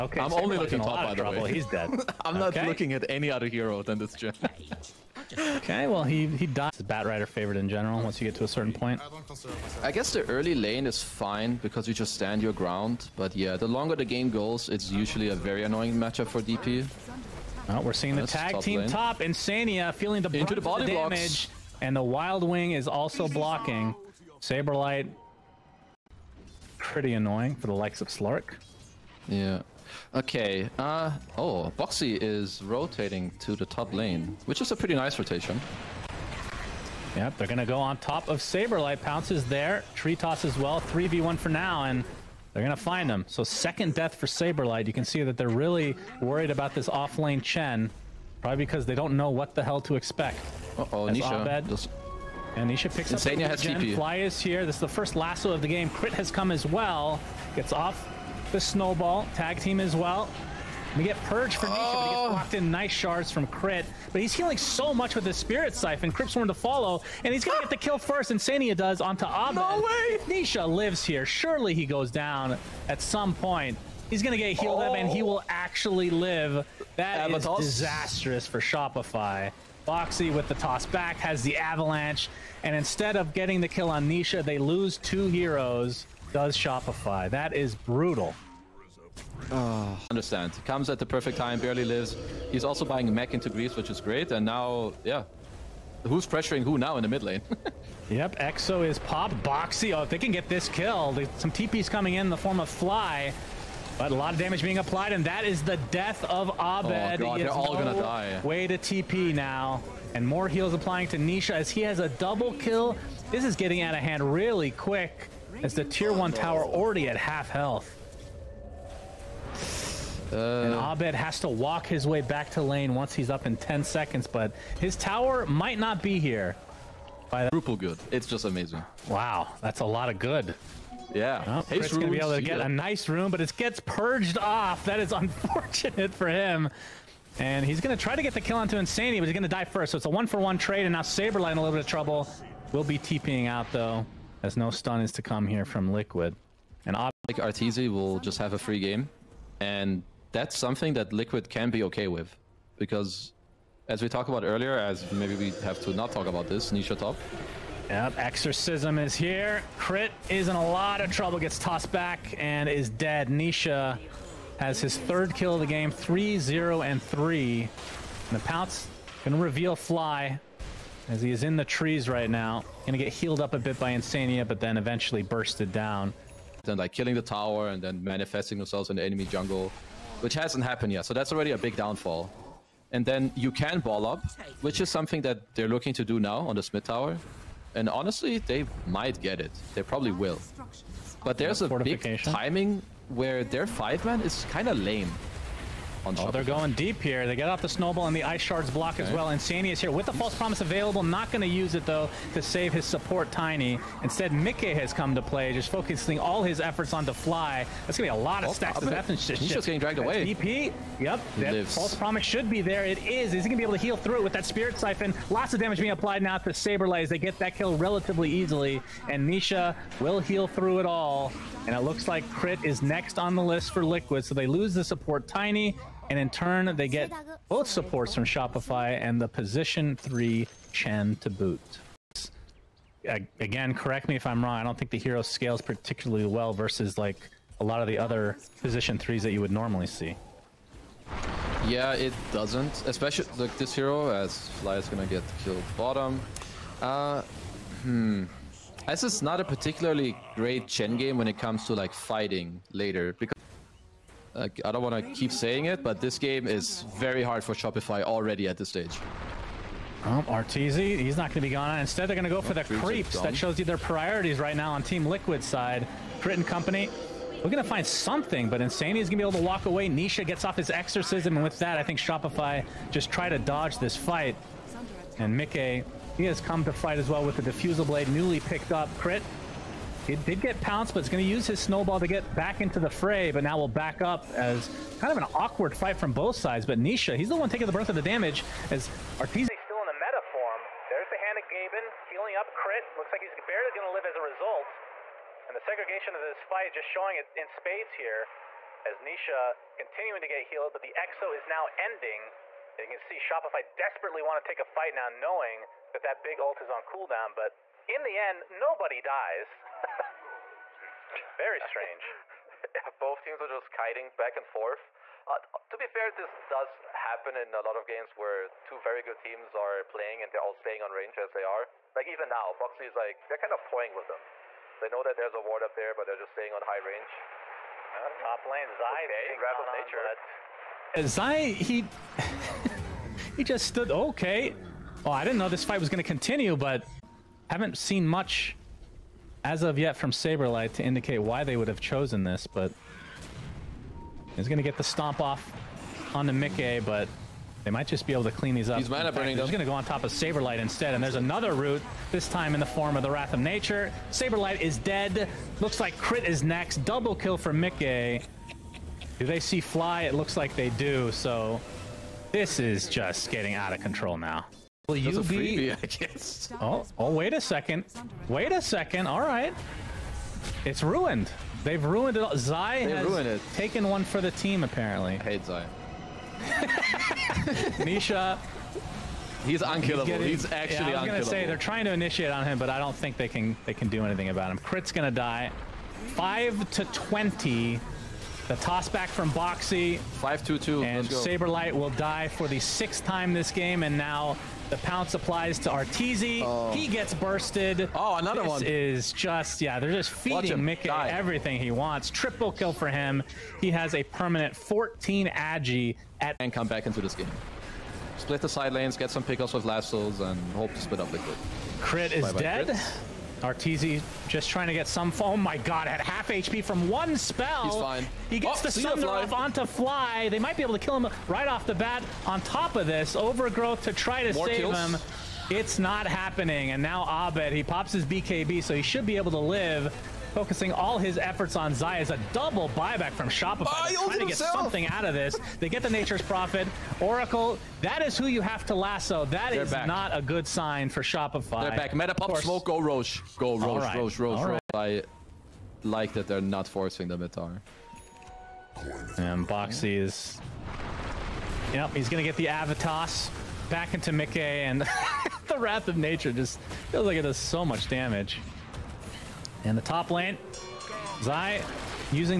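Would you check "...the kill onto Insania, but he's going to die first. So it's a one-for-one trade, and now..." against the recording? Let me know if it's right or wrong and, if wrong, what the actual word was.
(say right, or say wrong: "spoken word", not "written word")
right.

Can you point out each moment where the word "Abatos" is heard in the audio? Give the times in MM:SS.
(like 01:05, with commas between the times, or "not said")
01:17.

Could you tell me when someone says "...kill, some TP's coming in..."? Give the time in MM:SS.
01:40.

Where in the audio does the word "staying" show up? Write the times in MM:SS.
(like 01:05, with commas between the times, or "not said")
05:20, 05:26.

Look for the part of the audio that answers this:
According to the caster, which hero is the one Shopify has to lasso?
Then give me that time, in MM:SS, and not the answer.
07:16.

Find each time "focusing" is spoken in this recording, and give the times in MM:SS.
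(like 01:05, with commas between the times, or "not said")
03:25, 07:10.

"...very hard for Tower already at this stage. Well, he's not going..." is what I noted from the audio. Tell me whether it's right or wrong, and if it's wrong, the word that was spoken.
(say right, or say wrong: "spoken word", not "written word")
wrong: "Shopify", not "Tower".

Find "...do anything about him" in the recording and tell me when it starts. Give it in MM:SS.
06:23.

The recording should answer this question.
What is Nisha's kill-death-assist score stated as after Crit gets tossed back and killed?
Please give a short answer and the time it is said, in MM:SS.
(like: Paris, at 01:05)
3-0-3, at 02:45.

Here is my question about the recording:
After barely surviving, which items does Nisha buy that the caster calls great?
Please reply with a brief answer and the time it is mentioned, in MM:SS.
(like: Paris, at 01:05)
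mech into Greaves, at 01:33.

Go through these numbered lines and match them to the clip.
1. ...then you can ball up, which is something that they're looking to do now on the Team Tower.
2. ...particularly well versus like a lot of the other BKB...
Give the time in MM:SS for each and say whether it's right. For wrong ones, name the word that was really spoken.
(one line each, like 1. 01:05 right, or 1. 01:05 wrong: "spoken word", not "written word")
1. 03:03 wrong: "Smith", not "Team"
2. 03:55 wrong: "Position", not "BKB".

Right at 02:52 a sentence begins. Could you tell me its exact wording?
Gonna get healed up a bit by Insania, but then eventually bursted down.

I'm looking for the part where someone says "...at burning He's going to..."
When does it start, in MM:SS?
05:49.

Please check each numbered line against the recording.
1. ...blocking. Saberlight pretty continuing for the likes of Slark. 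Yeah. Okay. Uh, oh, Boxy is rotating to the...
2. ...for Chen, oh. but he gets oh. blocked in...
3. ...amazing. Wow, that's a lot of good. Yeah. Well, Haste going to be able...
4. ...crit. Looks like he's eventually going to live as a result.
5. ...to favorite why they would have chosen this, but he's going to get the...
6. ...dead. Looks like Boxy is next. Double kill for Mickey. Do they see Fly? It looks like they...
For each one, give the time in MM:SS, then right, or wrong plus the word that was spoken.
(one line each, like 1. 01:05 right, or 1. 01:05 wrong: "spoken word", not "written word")
1. 00:23 wrong: "annoying", not "continuing"
2. 01:01 wrong: "Nisha", not "Chen"
3. 02:08 right
4. 04:52 wrong: "barely", not "eventually"
5. 05:40 wrong: "indicate", not "favorite"
6. 05:54 wrong: "Crit", not "Boxy".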